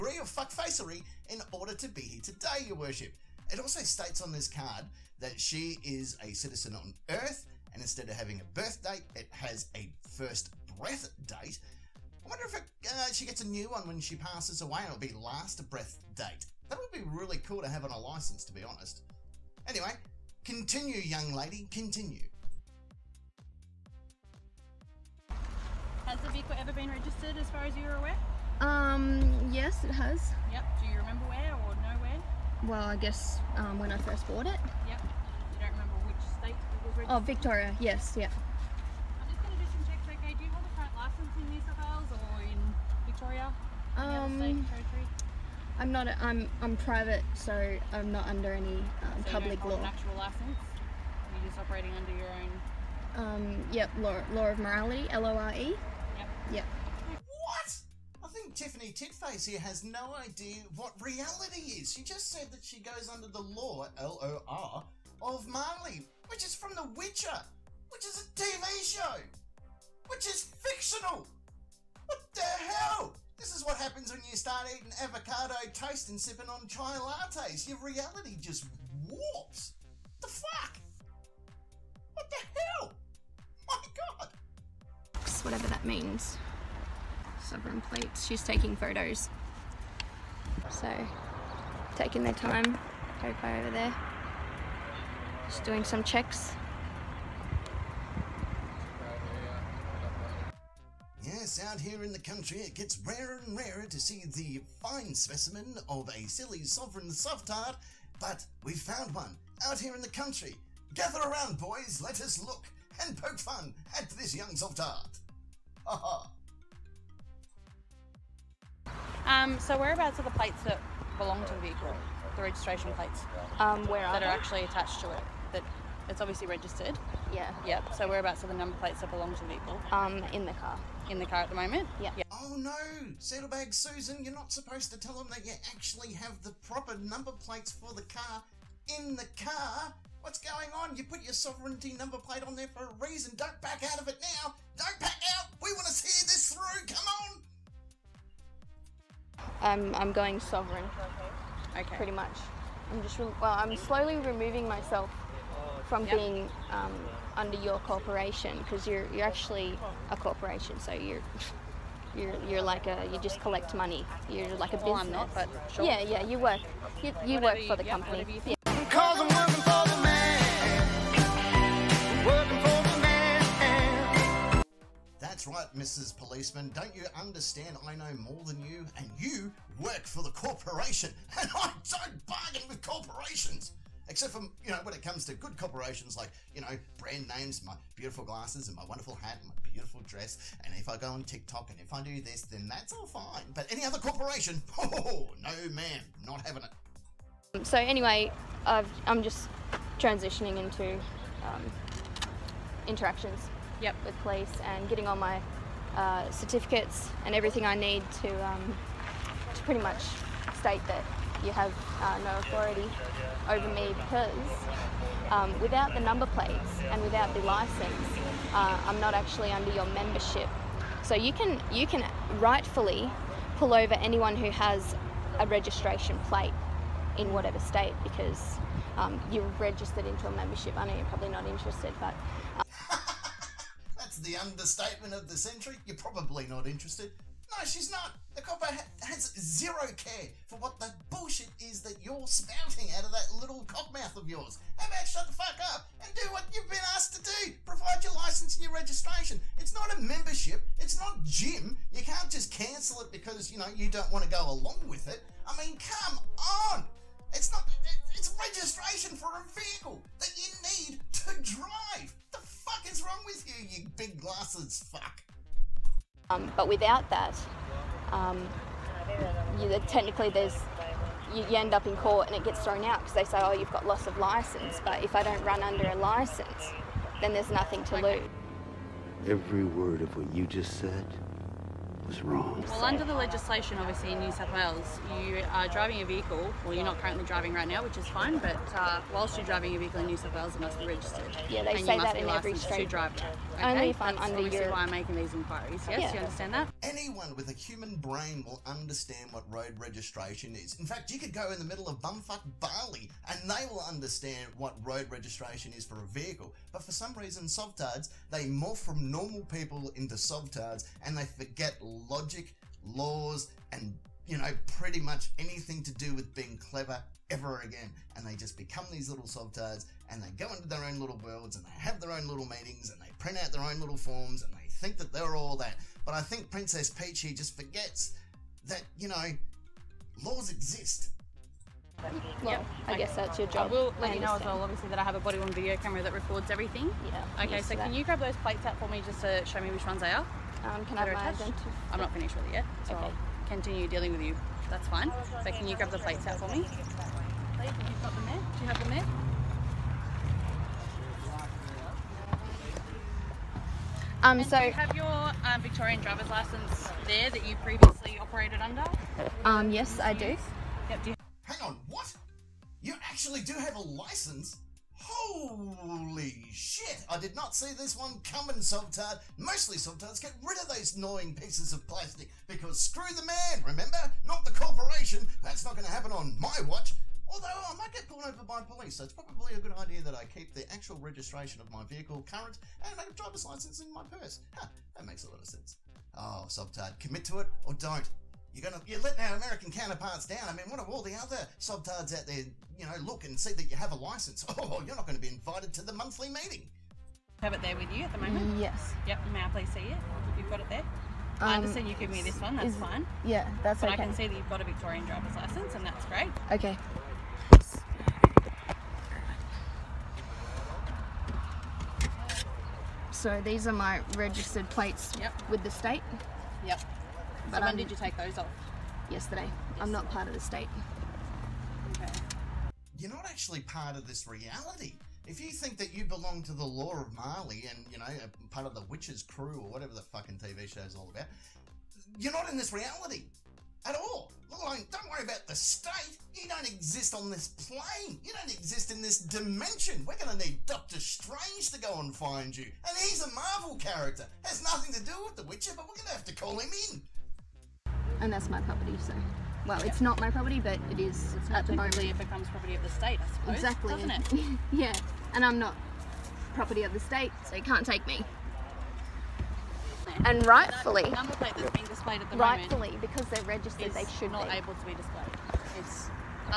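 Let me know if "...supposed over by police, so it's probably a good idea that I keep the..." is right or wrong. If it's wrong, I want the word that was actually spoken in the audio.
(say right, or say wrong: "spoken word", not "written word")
wrong: "pulled", not "supposed".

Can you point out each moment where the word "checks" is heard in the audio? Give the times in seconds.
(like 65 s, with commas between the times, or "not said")
39 s, 96 s.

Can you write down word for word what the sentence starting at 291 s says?
Yeah, they and say that in every street.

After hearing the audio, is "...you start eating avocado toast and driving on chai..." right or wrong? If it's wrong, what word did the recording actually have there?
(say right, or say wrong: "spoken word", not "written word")
wrong: "sipping", not "driving".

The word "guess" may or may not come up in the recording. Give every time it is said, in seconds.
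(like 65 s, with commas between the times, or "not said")
32 s, 332 s.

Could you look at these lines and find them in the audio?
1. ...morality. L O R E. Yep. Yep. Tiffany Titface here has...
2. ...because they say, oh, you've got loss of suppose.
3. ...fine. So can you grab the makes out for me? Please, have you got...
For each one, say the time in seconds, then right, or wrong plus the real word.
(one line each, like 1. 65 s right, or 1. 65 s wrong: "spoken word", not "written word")
1. 54 s right
2. 272 s wrong: "license", not "suppose"
3. 344 s wrong: "plates", not "makes".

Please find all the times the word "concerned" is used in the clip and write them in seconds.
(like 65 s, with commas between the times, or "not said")
not said.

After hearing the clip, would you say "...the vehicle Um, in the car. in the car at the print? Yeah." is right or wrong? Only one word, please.
wrong.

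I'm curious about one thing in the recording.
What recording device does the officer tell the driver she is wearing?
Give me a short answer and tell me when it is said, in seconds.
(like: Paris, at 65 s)
Body-worn video camera, at 335 s.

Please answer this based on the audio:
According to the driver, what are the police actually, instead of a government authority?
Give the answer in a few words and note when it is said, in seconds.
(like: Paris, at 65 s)
A corporation, at 160 s.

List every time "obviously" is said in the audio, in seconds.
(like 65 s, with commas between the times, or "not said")
126 s, 283 s, 294 s, 334 s.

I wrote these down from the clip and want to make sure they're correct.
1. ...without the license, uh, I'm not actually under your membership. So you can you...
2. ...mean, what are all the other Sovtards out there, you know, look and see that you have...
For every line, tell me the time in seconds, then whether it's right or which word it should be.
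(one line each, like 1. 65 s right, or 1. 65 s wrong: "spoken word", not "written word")
1. 217 s right
2. 390 s right.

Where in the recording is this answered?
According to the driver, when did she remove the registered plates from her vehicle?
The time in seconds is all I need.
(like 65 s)
419 s.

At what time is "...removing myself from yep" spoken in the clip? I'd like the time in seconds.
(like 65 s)
154 s.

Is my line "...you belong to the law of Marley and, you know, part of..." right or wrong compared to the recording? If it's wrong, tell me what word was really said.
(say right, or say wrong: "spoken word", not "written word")
right.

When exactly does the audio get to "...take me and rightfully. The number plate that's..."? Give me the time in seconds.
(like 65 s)
457 s.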